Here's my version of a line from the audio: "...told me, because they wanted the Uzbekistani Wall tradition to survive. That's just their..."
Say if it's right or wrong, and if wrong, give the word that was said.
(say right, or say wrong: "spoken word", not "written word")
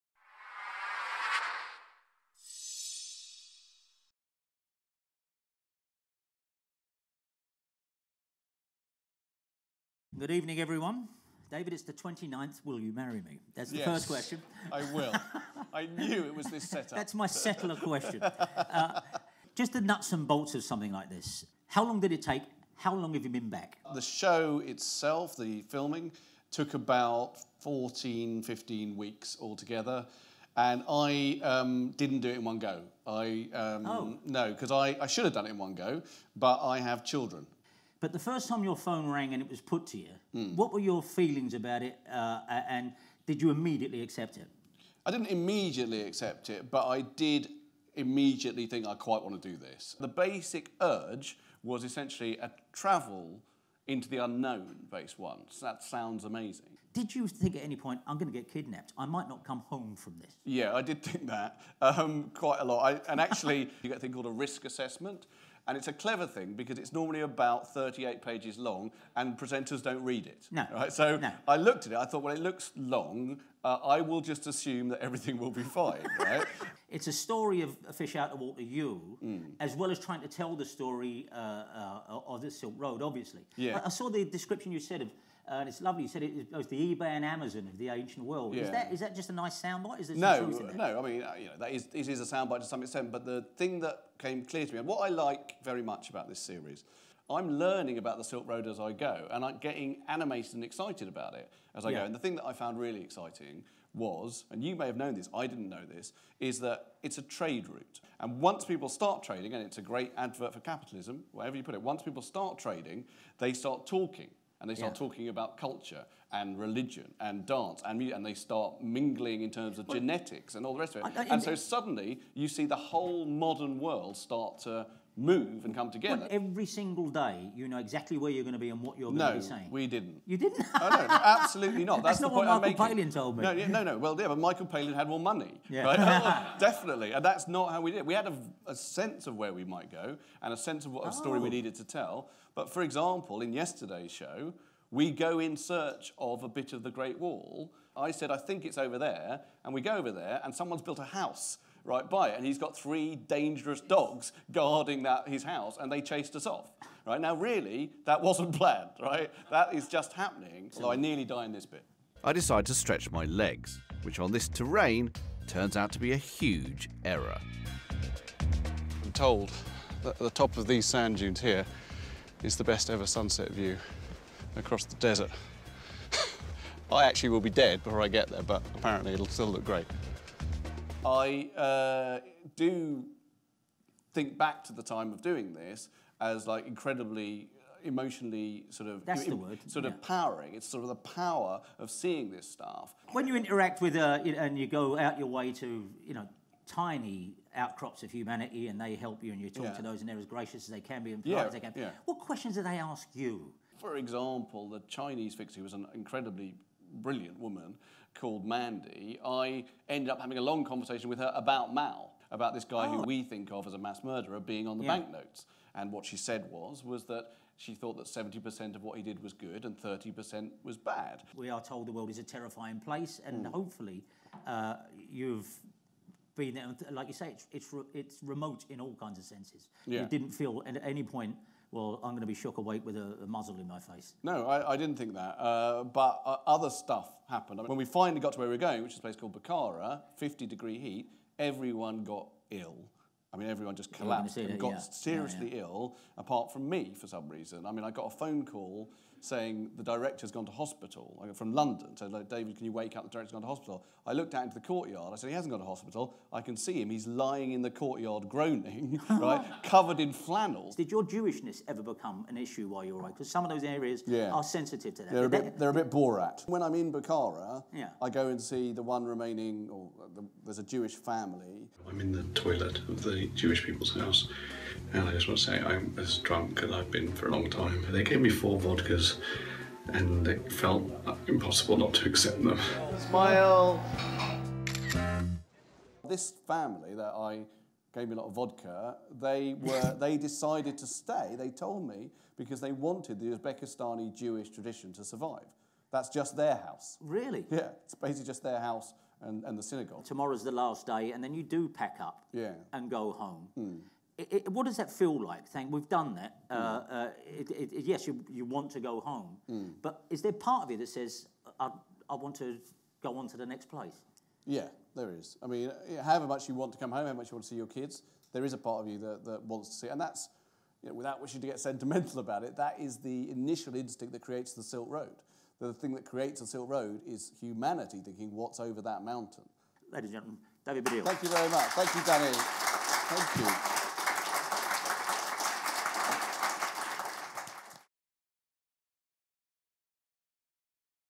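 wrong: "Jewish", not "Wall".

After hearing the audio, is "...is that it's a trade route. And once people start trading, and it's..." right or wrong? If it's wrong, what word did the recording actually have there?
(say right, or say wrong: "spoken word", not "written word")
right.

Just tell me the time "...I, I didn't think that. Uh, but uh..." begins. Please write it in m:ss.
3:54.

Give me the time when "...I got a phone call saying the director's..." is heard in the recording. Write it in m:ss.
4:07.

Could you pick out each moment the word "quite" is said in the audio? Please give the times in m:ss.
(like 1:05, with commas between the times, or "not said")
0:48, 1:02.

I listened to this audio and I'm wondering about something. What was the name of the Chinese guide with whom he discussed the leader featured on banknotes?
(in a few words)
Mandy.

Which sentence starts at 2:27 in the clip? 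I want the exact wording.
I said, I think it's over there.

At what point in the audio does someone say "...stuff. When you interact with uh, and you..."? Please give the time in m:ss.
3:12.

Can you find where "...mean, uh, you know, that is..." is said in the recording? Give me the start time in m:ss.
1:31.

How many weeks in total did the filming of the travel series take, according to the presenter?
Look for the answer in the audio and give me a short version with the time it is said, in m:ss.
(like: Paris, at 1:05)
14 or 15 weeks, at 0:27.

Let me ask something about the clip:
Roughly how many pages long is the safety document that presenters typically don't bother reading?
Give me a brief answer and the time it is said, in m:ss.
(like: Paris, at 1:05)
38, at 1:07.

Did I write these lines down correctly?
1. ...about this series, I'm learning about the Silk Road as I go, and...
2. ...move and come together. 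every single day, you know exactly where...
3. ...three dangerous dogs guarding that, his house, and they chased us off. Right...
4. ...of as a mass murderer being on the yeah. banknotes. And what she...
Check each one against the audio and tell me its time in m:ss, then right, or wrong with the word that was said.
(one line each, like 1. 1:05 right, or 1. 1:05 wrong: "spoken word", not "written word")
1. 1:36 right
2. 2:05 right
3. 2:32 right
4. 3:33 right.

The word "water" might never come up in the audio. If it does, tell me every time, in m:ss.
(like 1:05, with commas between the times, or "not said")
1:18.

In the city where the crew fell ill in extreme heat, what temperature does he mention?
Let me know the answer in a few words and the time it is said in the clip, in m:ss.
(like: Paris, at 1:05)
50 degrees, at 4:00.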